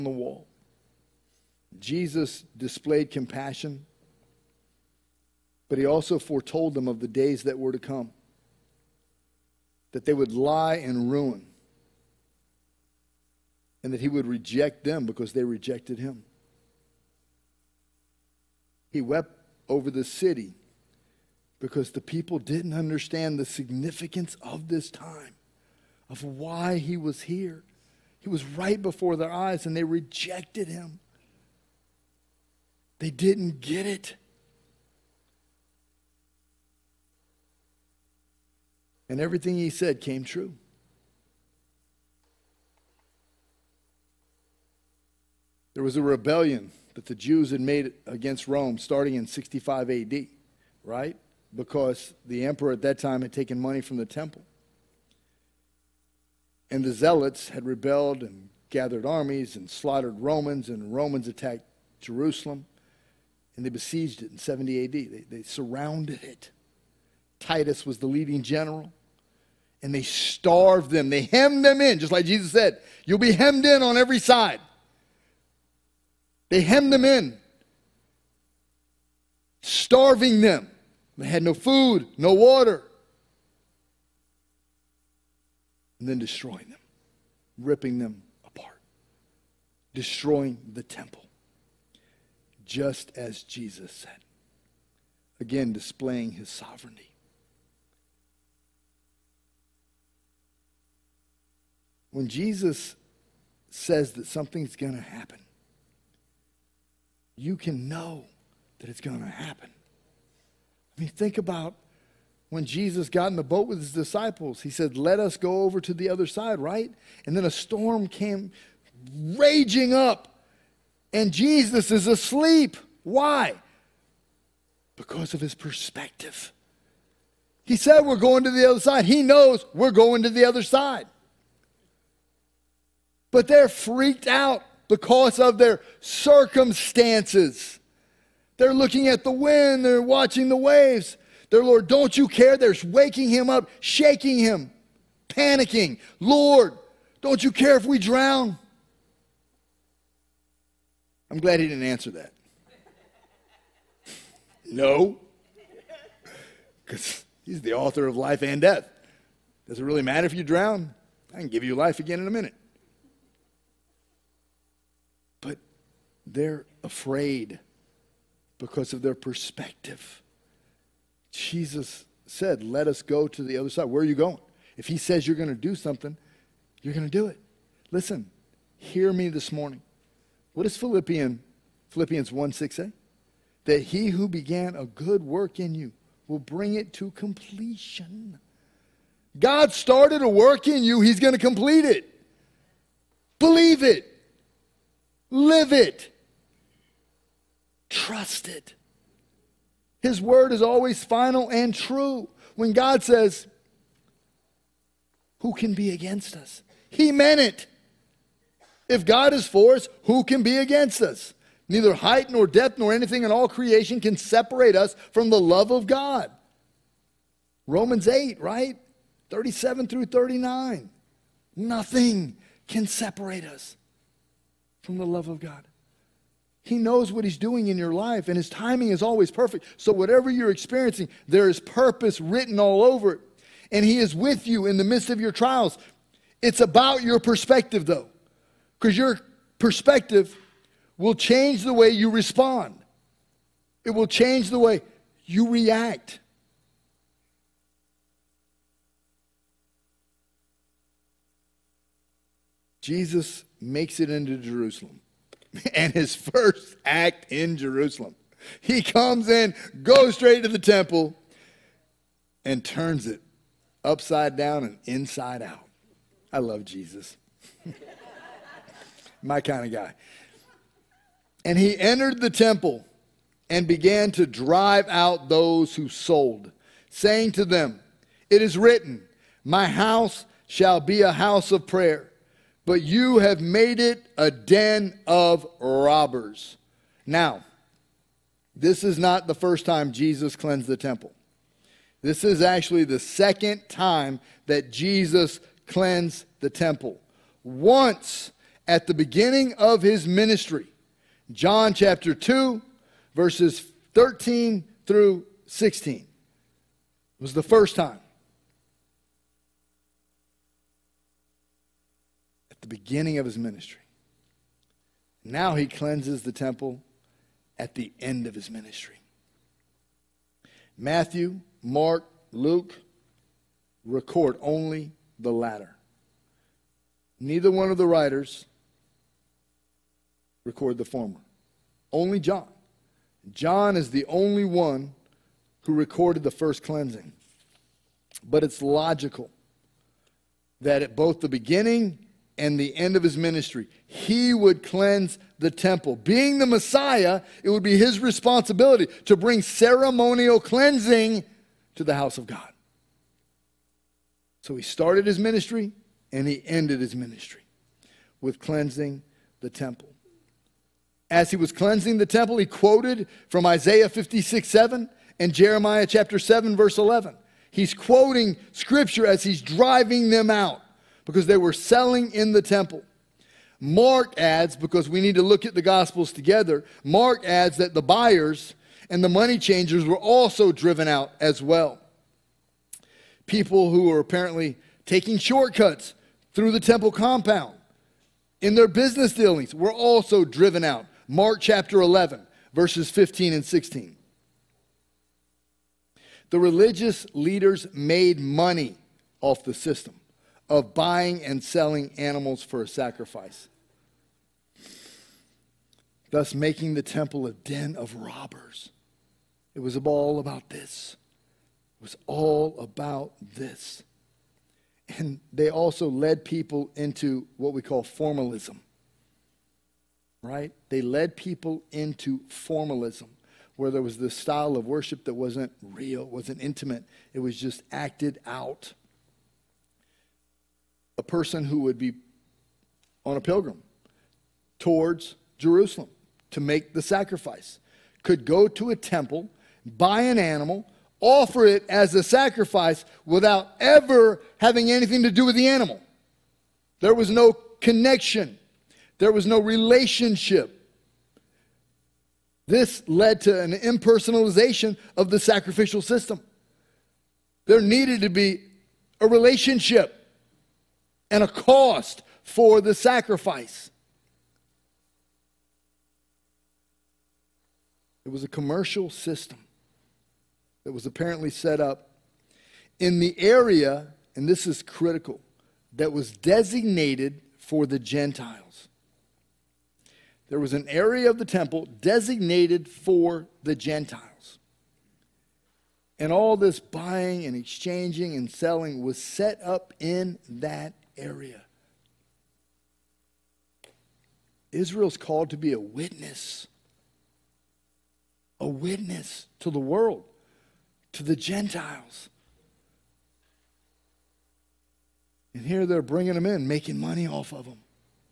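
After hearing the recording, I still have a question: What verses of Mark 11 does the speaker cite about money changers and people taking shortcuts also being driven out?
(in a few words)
15 and 16.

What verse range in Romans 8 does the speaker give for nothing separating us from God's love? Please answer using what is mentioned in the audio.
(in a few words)
37 through 39.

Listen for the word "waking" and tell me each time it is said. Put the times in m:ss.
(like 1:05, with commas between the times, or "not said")
2:22.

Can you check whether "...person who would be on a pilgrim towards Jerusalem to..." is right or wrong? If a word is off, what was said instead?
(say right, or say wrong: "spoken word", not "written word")
right.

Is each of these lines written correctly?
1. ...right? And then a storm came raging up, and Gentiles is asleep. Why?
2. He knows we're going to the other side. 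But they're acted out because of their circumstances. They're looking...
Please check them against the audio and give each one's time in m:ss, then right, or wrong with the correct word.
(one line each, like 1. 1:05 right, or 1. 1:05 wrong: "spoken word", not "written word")
1. 1:56 wrong: "Jesus", not "Gentiles"
2. 2:09 wrong: "freaked", not "acted".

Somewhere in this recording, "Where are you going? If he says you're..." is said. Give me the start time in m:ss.
2:53.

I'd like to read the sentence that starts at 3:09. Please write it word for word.
God started a work in you, he's going to complete it.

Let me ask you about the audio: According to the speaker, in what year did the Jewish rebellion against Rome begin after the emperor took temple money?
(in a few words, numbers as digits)
65 AD.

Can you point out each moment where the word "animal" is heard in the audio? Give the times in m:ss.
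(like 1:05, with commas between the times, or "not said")
6:41, 7:20, 7:25.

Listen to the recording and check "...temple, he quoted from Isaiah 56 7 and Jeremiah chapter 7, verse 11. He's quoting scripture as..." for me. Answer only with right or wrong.
right.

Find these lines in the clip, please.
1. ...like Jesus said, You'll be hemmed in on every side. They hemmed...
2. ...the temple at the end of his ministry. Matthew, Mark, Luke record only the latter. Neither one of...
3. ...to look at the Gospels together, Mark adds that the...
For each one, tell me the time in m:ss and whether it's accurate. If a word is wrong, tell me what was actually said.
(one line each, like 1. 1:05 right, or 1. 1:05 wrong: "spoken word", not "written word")
1. 1:12 right
2. 5:16 right
3. 6:15 right.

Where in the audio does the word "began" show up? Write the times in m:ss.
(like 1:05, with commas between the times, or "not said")
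3:04, 4:33.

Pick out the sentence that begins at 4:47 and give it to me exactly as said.
Now, this is not the first time Jesus cleansed the temple.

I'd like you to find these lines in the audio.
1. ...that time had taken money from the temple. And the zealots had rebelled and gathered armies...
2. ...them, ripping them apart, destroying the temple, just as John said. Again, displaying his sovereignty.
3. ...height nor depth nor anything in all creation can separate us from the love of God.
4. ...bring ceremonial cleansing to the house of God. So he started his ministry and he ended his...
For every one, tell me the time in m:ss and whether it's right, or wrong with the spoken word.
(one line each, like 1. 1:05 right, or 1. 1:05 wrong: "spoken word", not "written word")
1. 0:52 right
2. 1:26 wrong: "Jesus", not "John"
3. 3:31 right
4. 5:49 right.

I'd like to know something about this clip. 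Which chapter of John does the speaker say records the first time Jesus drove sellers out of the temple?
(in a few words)
John chapter 2.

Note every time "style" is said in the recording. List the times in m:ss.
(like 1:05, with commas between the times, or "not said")
7:04.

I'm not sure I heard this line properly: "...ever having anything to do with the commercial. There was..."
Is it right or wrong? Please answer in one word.
wrong.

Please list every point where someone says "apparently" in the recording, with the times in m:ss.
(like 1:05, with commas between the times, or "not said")
6:23, 7:50.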